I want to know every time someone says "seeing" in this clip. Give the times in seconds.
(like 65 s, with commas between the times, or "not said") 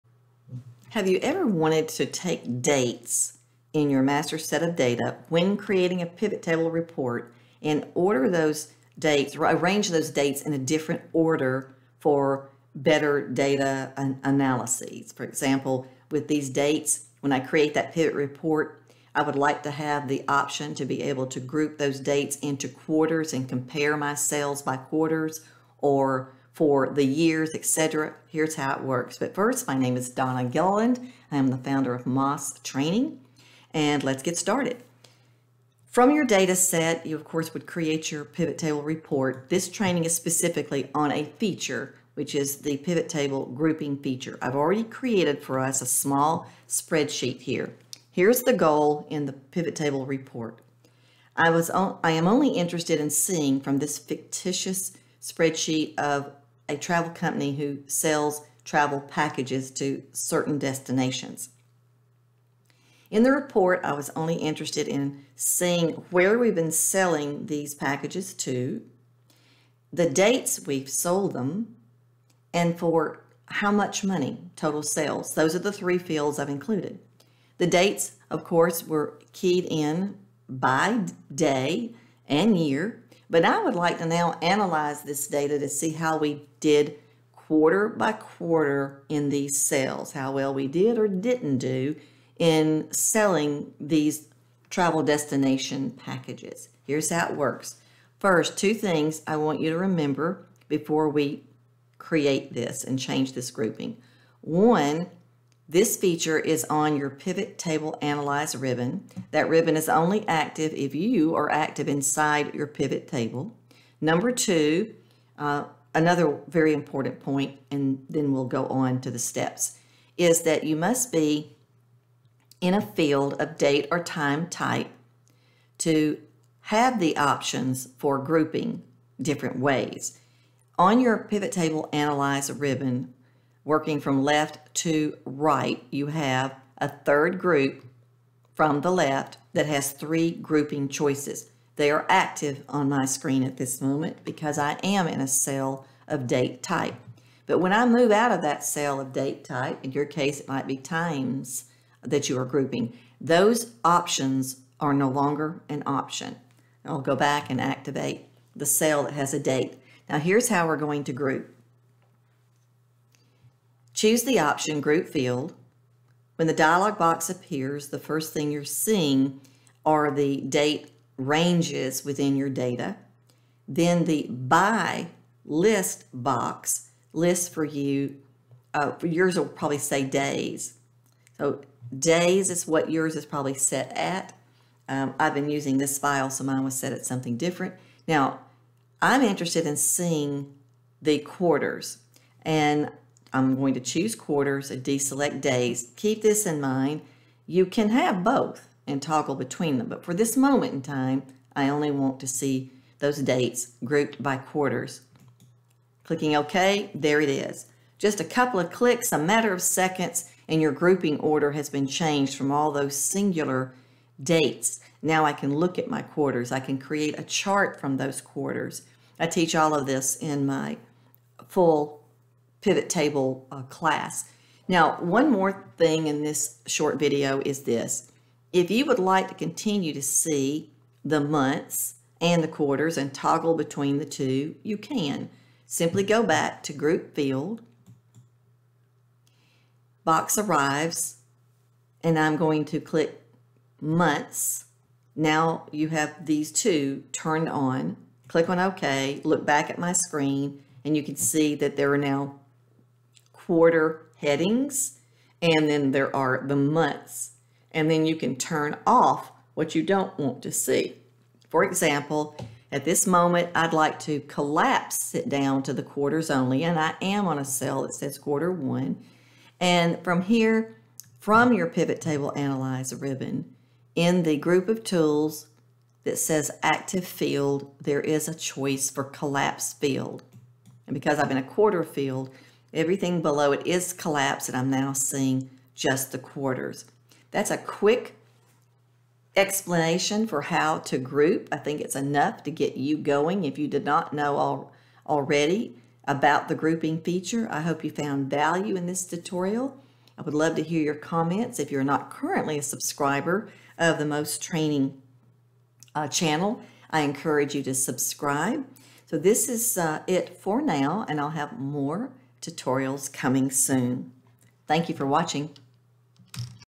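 53 s, 65 s, 168 s, 189 s, 284 s.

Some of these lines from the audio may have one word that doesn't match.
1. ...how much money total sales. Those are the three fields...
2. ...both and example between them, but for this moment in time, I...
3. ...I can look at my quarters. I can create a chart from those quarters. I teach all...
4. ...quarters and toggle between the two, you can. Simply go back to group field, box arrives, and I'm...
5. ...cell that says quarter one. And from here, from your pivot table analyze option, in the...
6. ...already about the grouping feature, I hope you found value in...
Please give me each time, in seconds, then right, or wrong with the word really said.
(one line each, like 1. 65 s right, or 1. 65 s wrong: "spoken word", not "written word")
1. 73 s right
2. 198 s wrong: "toggle", not "example"
3. 215 s right
4. 232 s right
5. 267 s wrong: "ribbon", not "option"
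6. 295 s right.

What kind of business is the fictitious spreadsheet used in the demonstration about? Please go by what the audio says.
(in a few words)
travel company.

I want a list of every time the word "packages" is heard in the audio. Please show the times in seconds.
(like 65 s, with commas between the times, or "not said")
59 s, 67 s, 95 s.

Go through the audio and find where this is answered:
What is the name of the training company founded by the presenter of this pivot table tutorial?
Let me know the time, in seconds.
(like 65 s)
32 s.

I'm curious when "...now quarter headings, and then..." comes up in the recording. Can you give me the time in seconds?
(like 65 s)
251 s.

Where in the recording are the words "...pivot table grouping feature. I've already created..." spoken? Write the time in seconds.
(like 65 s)
42 s.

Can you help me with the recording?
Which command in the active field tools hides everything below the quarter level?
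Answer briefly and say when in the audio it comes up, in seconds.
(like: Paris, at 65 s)
collapse field, at 279 s.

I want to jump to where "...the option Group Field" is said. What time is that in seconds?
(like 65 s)
164 s.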